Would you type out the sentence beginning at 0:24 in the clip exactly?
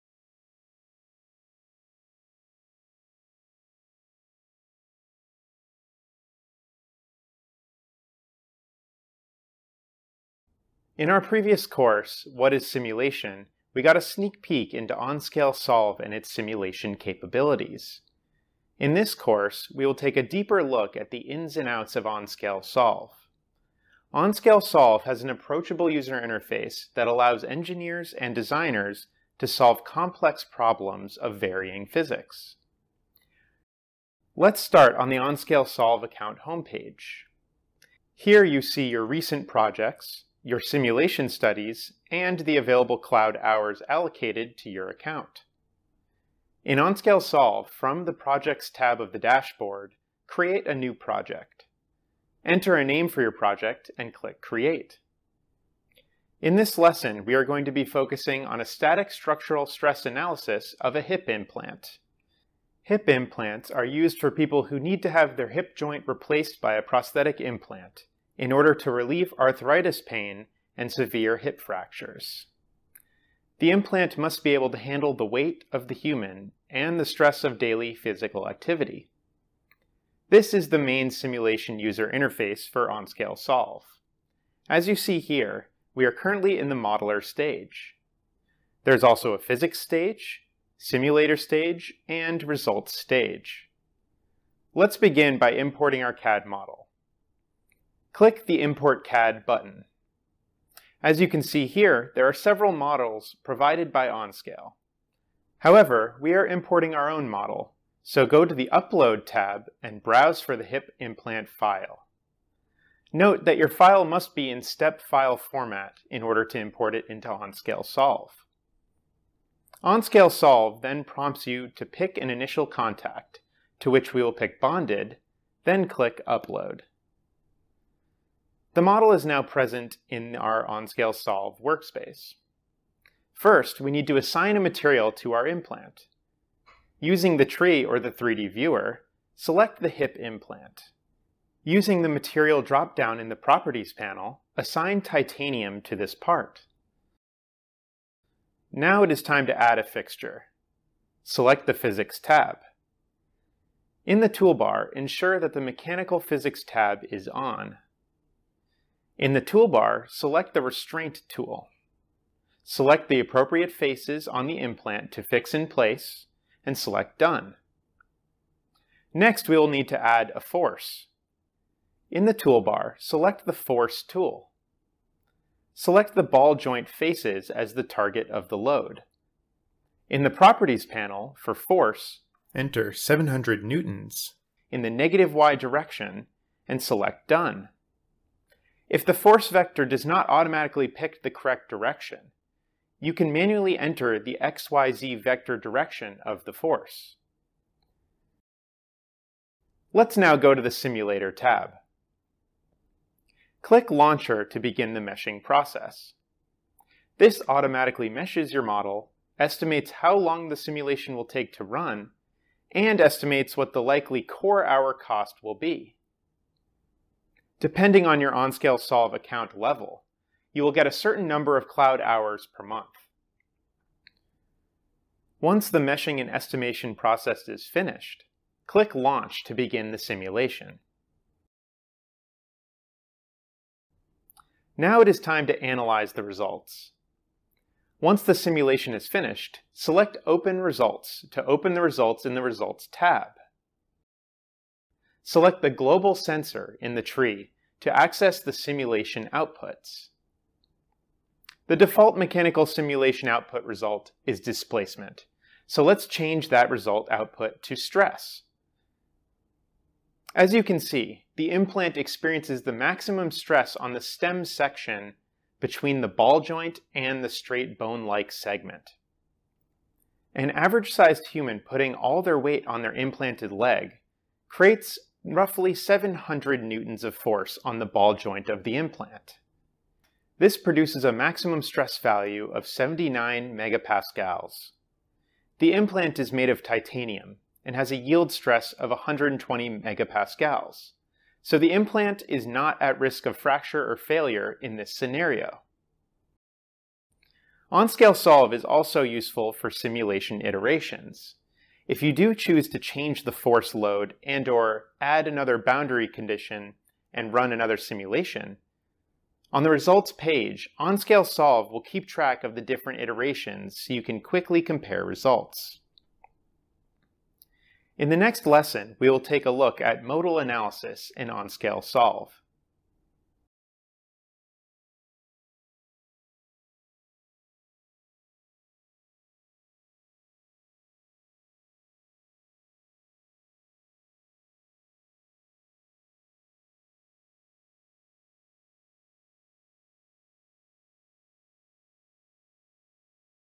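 OnScale Solve has an approachable user interface that allows engineers and designers to solve complex problems of varying physics.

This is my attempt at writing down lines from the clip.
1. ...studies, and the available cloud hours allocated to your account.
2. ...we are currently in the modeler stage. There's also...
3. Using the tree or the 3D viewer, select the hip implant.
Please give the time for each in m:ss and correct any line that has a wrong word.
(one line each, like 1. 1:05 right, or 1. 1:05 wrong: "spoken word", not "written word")
1. 0:41 right
2. 1:25 right
3. 2:17 right.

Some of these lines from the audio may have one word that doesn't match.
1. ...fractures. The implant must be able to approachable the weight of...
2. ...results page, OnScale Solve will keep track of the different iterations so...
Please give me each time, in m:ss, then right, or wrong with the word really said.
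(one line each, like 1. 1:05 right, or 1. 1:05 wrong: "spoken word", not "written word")
1. 1:11 wrong: "handle", not "approachable"
2. 5:09 right.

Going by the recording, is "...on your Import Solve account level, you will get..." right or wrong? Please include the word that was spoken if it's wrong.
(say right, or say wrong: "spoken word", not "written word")
wrong: "OnScale", not "Import".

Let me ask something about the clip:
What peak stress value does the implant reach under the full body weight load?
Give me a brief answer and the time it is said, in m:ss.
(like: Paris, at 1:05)
79 megapascals, at 4:42.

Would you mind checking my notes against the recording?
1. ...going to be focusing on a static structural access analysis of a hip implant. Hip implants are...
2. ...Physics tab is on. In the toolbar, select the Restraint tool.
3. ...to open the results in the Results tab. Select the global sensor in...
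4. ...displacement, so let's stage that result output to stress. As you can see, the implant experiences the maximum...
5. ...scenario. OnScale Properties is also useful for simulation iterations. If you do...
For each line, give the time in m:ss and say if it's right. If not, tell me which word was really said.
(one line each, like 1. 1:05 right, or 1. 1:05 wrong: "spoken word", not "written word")
1. 0:57 wrong: "stress", not "access"
2. 2:36 right
3. 4:01 right
4. 4:14 wrong: "change", not "stage"
5. 4:54 wrong: "Solve", not "Properties".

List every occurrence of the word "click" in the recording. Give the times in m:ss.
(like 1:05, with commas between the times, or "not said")
0:54, 1:38, 2:05, 3:23, 3:48.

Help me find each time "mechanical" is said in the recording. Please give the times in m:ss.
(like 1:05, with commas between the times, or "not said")
2:35, 4:12.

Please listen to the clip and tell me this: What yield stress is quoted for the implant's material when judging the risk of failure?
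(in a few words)
120 megapascals.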